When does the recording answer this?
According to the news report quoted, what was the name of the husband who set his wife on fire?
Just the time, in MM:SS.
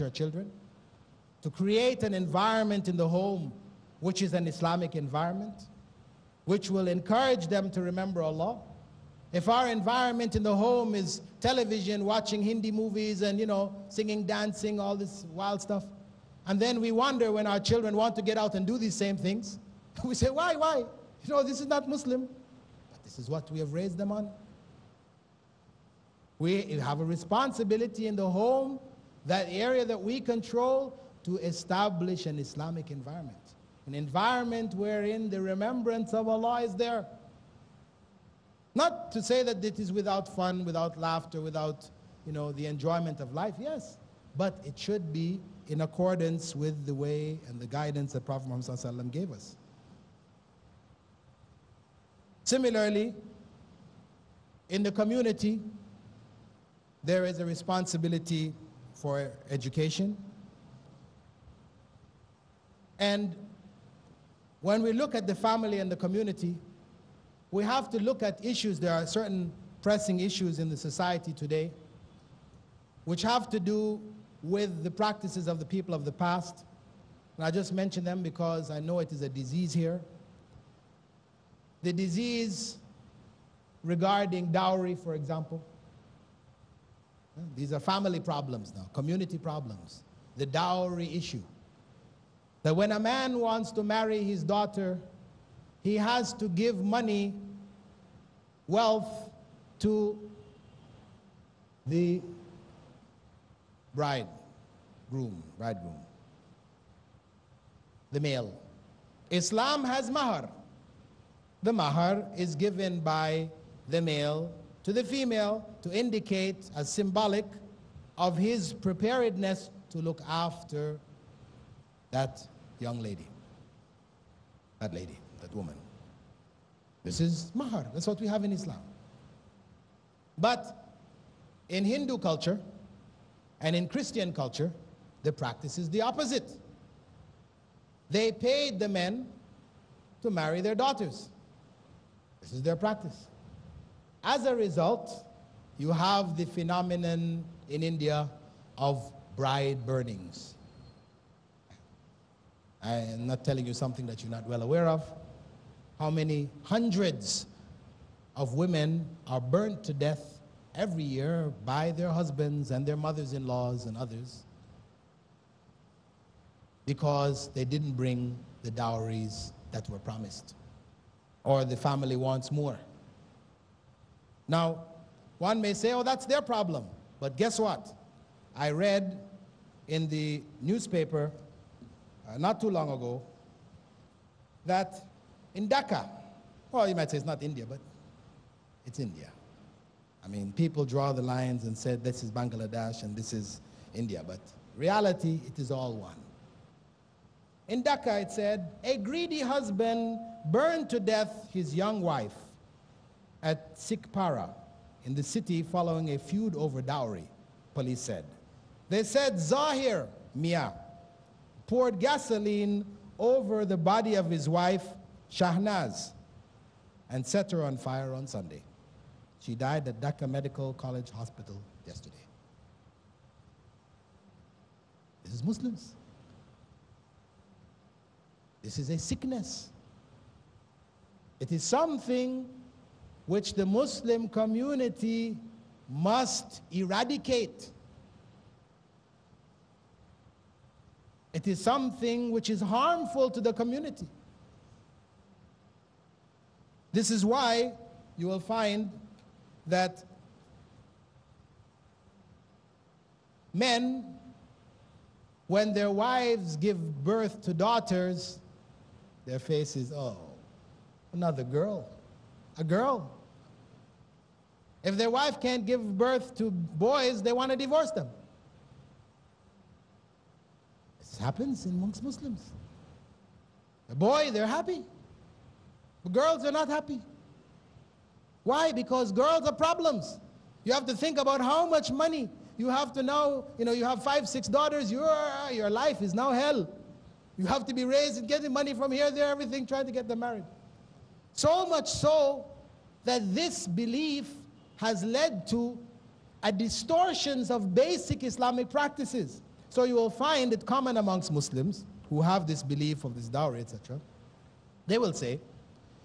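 03:29.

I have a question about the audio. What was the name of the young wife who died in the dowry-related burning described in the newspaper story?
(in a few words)
Shahnaz.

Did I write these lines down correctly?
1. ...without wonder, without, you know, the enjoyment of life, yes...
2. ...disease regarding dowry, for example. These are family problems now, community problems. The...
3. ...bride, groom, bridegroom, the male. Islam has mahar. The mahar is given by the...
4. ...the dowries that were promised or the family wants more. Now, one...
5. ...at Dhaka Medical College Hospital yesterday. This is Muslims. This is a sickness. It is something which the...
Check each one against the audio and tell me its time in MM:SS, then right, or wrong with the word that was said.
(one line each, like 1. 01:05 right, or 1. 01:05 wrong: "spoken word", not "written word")
1. 00:40 wrong: "laughter", not "wonder"
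2. 01:21 right
3. 01:43 right
4. 02:48 right
5. 03:39 right.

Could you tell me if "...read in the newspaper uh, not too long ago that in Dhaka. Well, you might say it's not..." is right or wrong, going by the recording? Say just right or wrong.
right.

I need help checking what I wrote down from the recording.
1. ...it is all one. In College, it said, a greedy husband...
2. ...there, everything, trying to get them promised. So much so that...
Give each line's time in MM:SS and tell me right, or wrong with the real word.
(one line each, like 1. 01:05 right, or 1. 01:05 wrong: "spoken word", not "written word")
1. 03:15 wrong: "Dhaka", not "College"
2. 04:49 wrong: "married", not "promised".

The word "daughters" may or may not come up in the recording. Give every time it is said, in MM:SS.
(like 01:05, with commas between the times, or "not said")
01:34, 02:20, 04:17, 04:44.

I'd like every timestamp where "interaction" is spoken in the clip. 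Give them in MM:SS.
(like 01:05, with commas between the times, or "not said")
not said.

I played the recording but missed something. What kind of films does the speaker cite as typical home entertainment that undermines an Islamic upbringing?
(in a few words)
Hindi movies.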